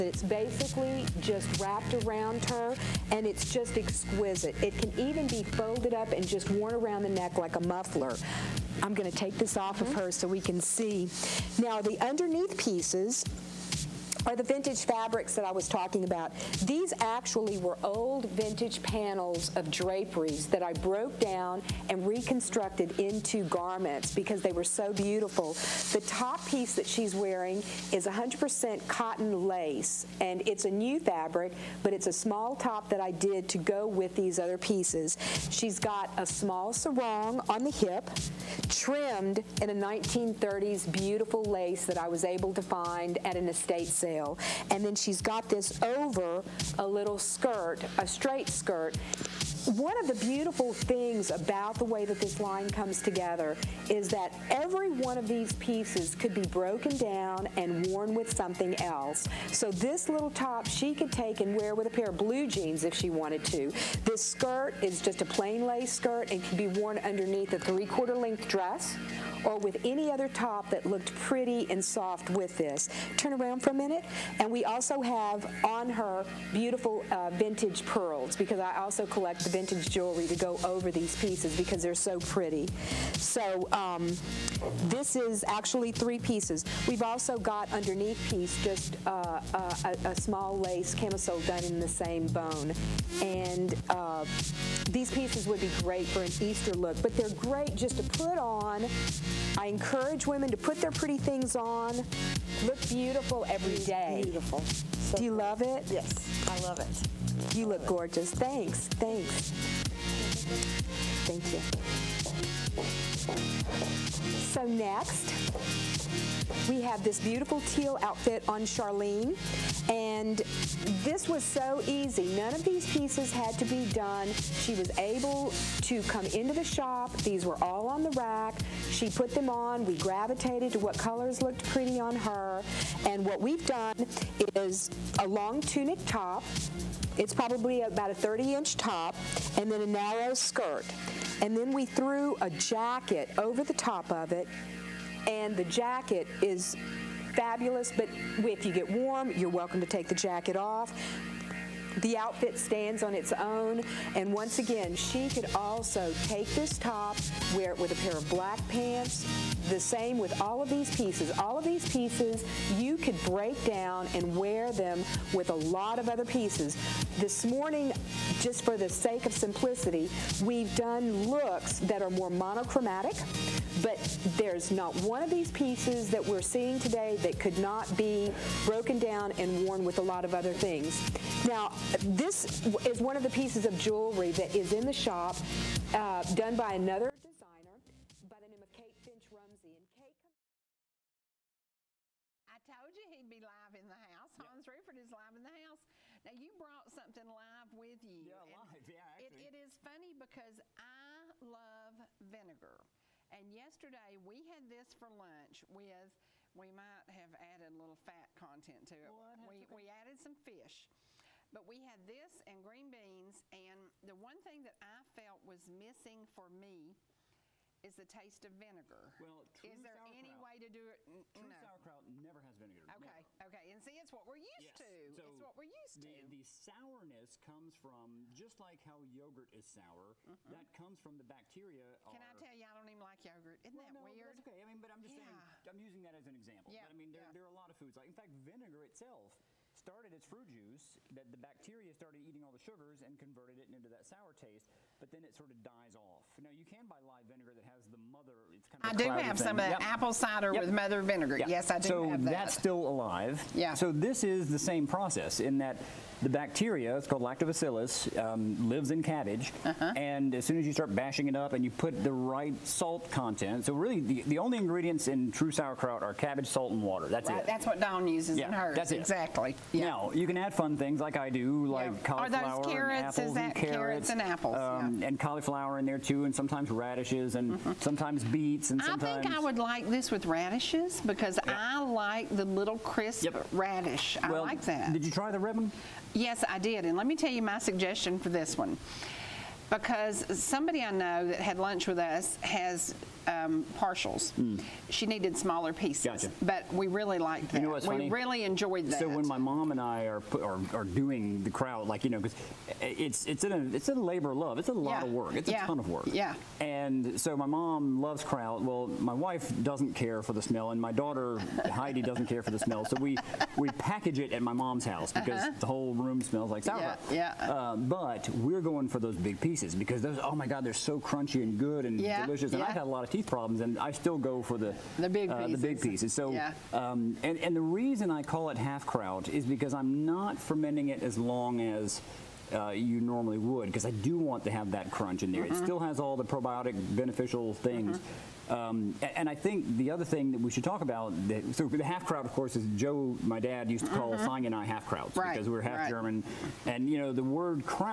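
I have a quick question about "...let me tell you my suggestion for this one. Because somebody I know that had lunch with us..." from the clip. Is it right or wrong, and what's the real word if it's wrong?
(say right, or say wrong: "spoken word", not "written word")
right.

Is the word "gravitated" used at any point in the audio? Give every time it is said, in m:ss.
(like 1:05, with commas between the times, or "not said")
2:09.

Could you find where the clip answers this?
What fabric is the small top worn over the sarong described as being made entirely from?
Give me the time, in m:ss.
0:28.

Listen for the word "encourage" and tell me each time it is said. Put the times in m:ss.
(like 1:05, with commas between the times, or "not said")
1:39.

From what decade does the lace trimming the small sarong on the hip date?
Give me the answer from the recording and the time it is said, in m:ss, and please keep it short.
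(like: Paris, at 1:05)
1930s, at 0:39.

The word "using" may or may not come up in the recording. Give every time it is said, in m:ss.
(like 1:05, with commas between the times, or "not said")
3:55.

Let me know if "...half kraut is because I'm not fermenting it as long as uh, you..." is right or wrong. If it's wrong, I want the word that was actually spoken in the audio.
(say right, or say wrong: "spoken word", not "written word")
right.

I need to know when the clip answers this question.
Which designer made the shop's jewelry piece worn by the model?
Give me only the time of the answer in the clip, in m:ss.
3:08.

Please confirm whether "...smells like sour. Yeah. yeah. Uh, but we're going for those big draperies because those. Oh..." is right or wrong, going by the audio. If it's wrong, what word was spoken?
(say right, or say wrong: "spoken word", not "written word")
wrong: "pieces", not "draperies".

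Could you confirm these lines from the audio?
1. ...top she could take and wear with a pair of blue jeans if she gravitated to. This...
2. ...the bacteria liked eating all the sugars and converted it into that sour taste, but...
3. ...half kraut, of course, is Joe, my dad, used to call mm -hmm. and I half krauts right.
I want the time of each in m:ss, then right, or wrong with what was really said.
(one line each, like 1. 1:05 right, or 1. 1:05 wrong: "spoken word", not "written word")
1. 1:00 wrong: "wanted", not "gravitated"
2. 4:01 wrong: "started", not "liked"
3. 5:41 right.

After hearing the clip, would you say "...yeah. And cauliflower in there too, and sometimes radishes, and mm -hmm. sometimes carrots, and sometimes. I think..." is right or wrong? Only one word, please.
wrong.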